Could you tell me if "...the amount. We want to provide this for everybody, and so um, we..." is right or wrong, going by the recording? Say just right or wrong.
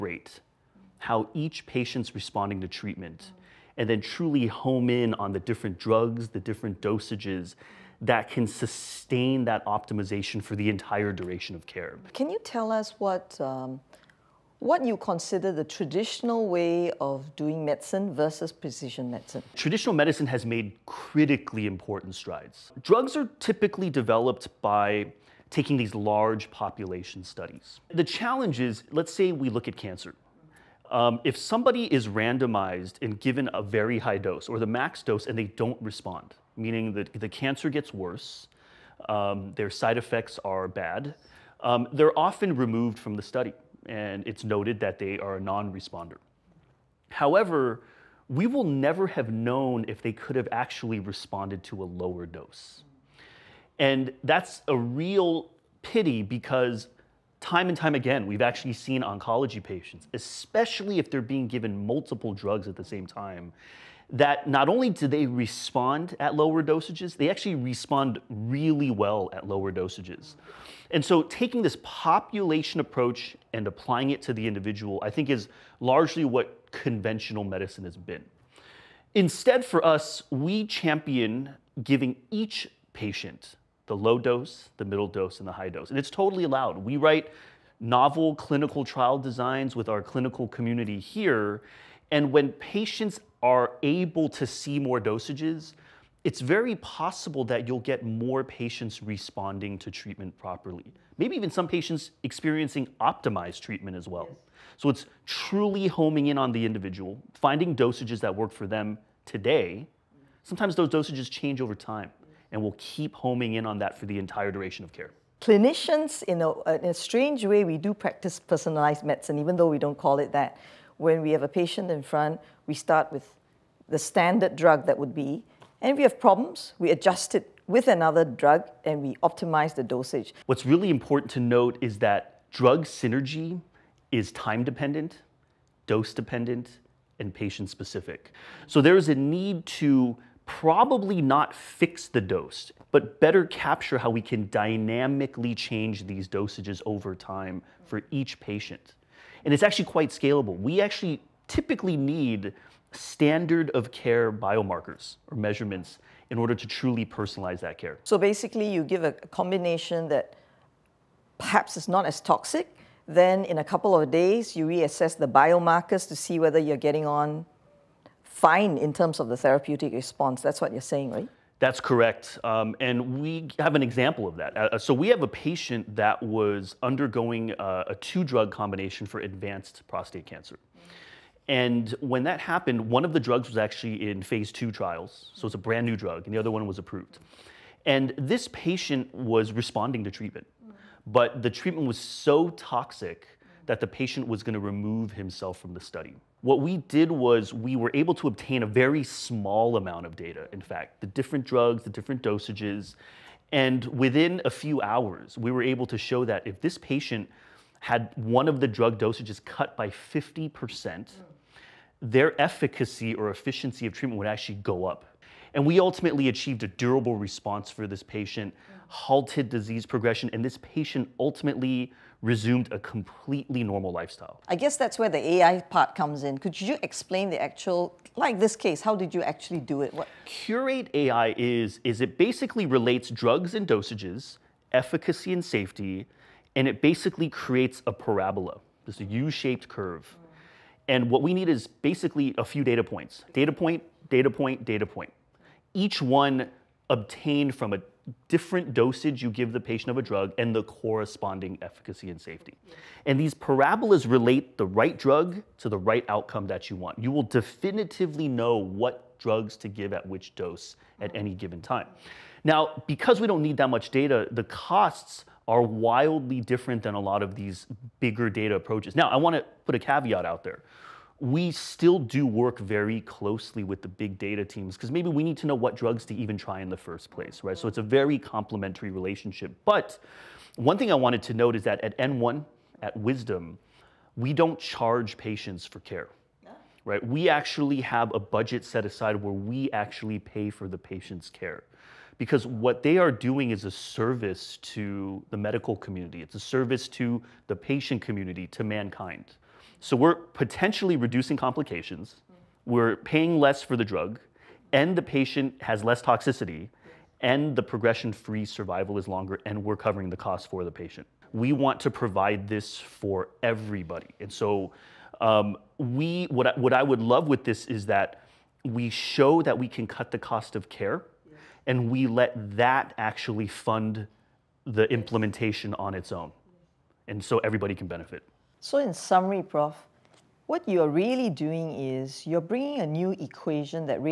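wrong.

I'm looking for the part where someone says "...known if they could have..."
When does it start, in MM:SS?
00:49.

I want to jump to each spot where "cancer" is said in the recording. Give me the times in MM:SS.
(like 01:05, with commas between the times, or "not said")
00:29, 00:37, 03:00.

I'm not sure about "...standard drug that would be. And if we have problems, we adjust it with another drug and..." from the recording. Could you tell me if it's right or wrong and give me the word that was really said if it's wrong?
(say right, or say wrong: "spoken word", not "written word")
right.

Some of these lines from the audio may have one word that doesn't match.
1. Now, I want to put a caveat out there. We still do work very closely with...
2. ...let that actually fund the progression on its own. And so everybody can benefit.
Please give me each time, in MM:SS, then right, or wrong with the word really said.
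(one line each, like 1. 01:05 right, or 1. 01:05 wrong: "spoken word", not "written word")
1. 04:28 right
2. 05:22 wrong: "implementation", not "progression".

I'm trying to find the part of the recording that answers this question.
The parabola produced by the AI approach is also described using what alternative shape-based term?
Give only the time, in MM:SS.
03:59.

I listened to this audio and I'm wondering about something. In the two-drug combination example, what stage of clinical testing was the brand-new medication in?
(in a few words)
Phase 2.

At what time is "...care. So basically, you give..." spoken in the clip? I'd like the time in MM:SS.
02:37.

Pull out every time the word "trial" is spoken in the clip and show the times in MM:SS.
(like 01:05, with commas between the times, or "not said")
01:28, 03:04.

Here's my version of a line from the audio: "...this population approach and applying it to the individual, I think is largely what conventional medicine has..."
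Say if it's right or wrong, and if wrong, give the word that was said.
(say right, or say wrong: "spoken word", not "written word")
right.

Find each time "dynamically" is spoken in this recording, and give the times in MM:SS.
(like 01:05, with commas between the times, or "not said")
02:24.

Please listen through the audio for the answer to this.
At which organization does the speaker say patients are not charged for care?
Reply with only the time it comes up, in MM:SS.
04:42.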